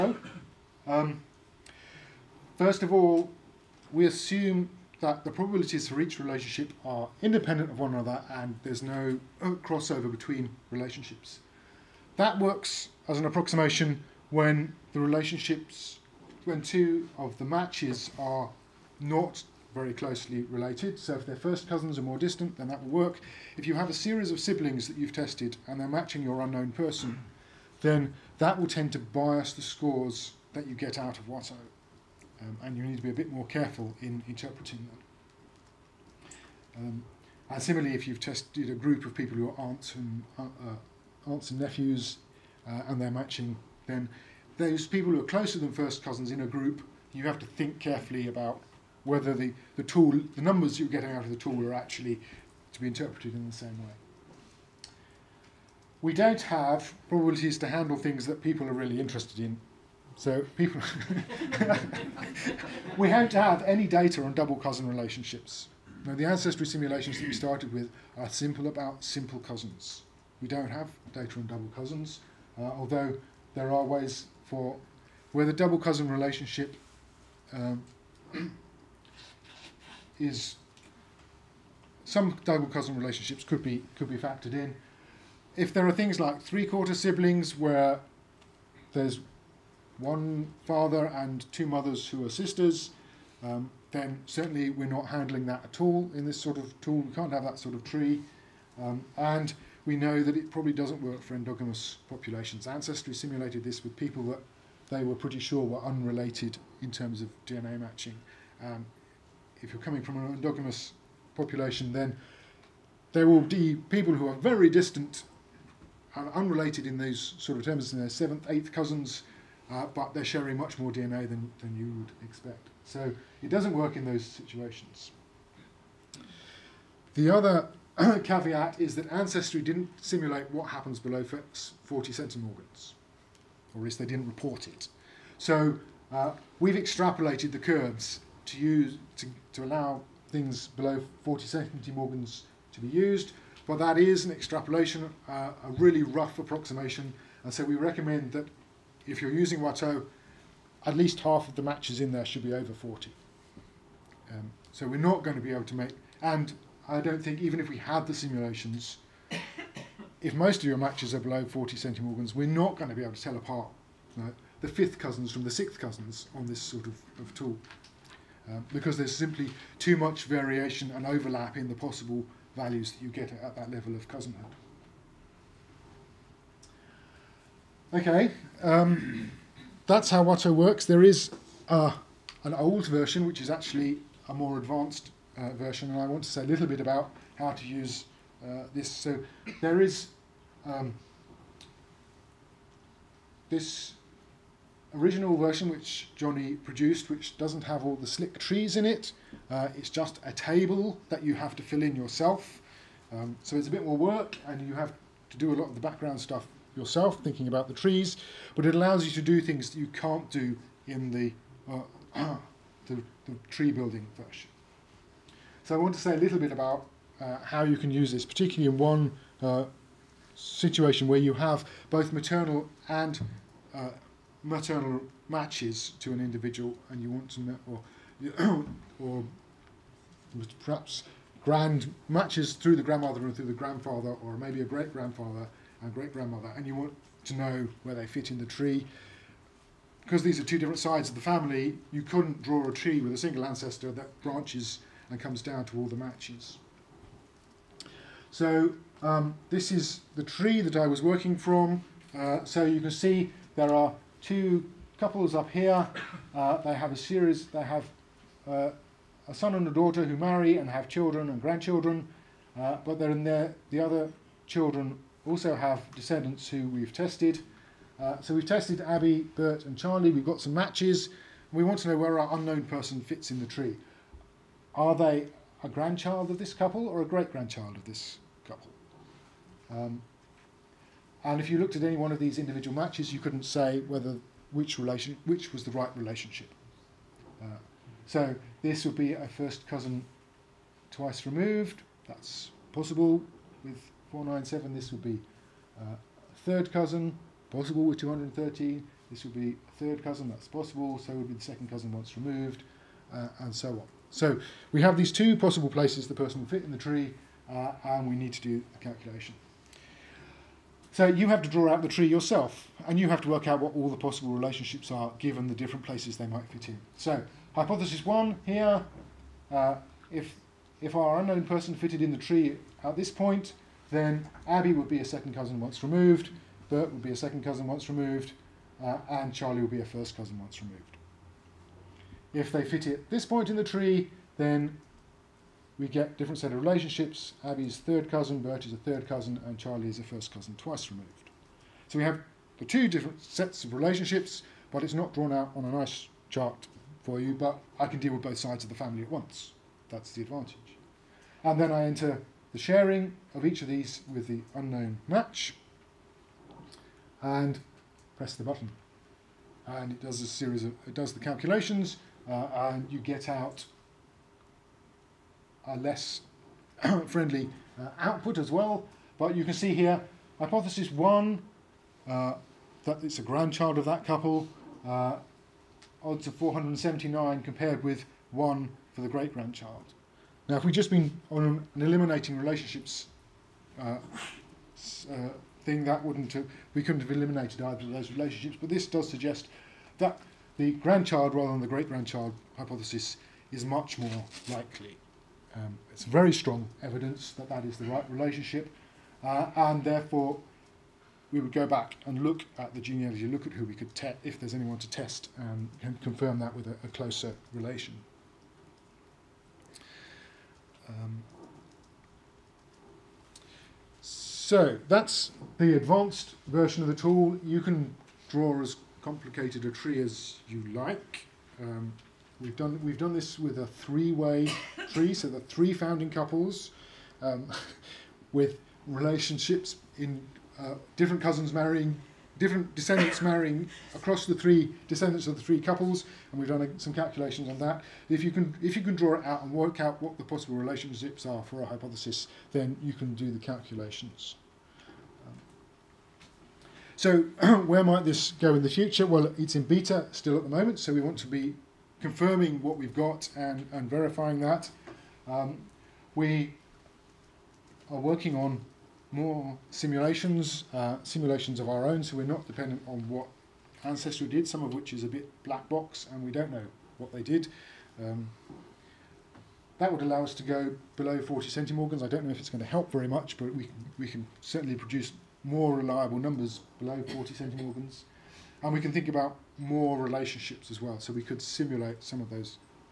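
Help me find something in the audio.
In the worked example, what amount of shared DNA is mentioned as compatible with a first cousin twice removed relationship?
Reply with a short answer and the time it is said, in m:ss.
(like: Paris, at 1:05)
497, at 4:54.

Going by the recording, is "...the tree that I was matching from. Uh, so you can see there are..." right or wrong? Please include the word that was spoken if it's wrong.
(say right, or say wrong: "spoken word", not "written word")
wrong: "working", not "matching".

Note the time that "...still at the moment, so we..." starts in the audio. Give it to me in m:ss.
7:30.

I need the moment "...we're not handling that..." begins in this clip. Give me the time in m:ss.
1:34.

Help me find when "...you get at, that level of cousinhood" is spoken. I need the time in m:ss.
2:53.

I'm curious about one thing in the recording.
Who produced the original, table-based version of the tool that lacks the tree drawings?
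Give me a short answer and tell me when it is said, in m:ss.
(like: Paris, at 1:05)
Johnny, at 3:16.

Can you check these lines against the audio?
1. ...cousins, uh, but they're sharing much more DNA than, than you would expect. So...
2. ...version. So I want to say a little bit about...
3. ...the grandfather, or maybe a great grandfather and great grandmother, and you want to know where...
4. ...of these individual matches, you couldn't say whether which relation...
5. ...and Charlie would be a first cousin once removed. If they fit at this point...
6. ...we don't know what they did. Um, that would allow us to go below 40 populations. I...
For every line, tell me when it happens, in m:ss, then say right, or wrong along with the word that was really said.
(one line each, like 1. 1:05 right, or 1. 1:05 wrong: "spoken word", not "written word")
1. 1:58 right
2. 3:34 right
3. 3:53 right
4. 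4:42 right
5. 5:29 right
6. 7:46 wrong: "centimorgans", not "populations".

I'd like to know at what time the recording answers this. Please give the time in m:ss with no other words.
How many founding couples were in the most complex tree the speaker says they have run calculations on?
7:05.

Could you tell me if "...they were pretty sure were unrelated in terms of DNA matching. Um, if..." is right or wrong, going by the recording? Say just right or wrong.
right.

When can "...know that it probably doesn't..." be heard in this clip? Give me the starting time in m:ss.
1:39.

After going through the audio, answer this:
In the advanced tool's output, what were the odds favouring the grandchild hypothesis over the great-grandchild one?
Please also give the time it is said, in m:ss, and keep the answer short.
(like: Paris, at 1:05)
479 to 1, at 6:16.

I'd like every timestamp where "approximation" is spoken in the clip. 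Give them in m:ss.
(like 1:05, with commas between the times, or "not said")
0:13, 2:26.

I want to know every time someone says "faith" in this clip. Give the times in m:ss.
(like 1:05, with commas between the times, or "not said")
not said.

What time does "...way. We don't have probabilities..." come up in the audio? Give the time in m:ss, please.
0:53.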